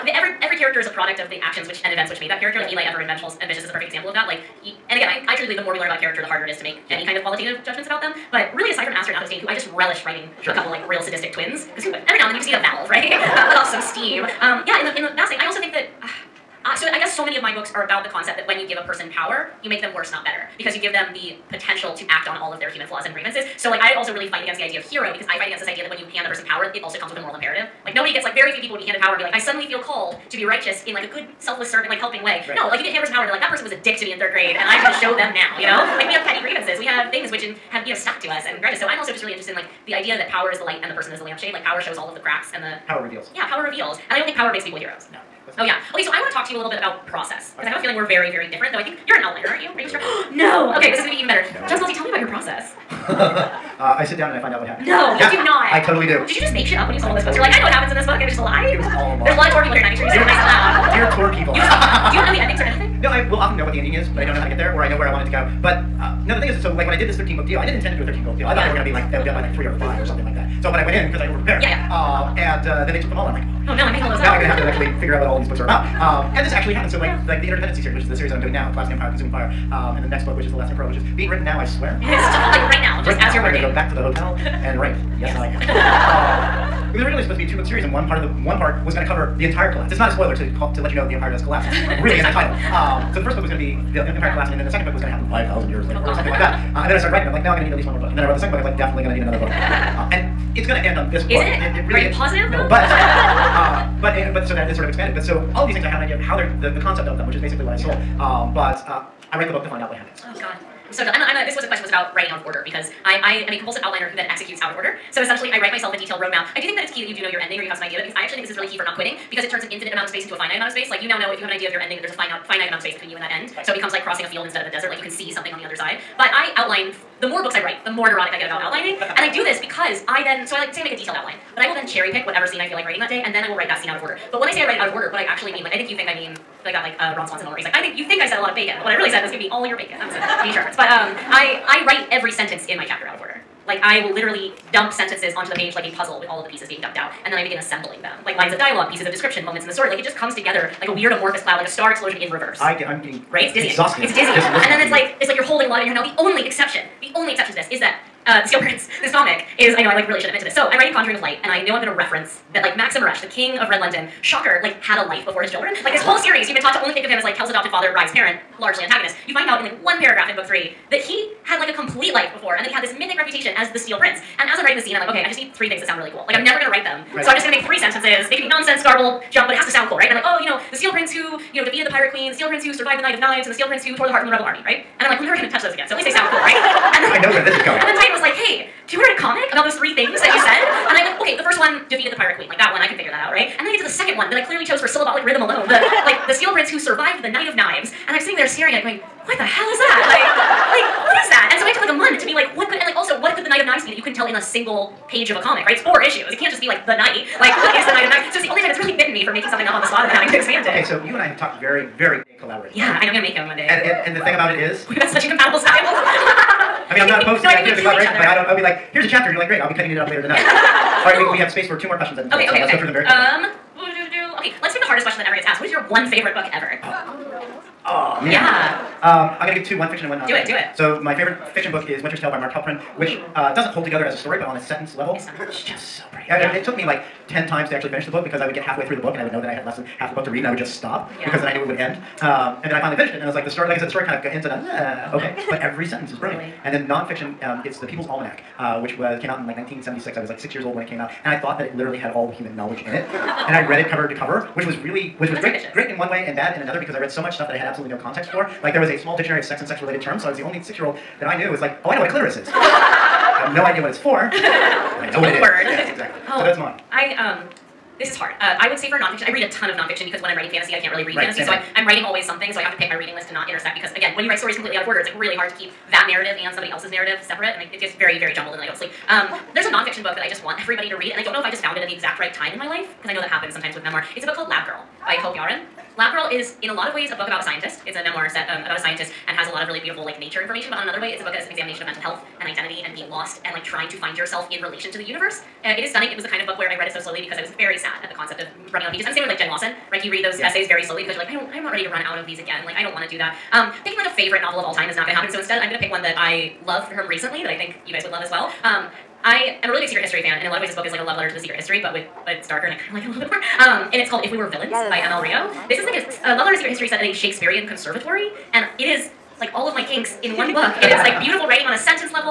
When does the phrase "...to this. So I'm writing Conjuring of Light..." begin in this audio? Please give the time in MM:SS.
02:40.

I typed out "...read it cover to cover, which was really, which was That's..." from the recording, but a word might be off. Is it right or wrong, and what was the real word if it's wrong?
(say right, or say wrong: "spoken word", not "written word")
right.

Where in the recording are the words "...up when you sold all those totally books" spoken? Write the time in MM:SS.
00:56.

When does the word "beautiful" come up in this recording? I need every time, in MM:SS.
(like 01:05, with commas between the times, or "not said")
04:49, 05:21.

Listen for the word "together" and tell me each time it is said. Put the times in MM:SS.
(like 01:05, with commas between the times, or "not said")
02:30, 03:53.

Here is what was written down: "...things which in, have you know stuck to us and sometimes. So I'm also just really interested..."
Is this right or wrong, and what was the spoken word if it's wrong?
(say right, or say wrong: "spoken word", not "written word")
wrong: "grudges", not "sometimes".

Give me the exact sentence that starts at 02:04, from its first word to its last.
Like you can see something on the other side.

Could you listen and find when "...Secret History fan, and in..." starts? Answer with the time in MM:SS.
05:09.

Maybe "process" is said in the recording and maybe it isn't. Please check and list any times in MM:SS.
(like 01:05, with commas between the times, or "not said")
00:47, 00:52.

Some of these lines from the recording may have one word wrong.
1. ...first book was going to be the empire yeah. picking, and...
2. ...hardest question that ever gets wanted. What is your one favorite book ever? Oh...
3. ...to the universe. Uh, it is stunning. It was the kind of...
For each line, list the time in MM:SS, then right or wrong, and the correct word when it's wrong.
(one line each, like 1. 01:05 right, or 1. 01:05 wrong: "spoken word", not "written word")
1. 01:33 wrong: "collapsing", not "picking"
2. 03:44 wrong: "asked", not "wanted"
3. 04:54 right.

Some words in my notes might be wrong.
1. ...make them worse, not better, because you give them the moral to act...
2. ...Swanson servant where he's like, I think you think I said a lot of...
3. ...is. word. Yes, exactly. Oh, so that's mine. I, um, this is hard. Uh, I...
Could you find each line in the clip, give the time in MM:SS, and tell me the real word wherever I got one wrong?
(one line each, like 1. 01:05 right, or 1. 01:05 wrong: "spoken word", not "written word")
1. 00:19 wrong: "potential", not "moral"
2. 02:17 wrong: "moment", not "servant"
3. 04:25 right.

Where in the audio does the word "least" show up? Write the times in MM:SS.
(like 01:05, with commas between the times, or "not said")
01:37, 03:05.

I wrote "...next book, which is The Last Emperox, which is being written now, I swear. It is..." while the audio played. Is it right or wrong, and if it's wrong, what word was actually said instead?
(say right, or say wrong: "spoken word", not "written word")
right.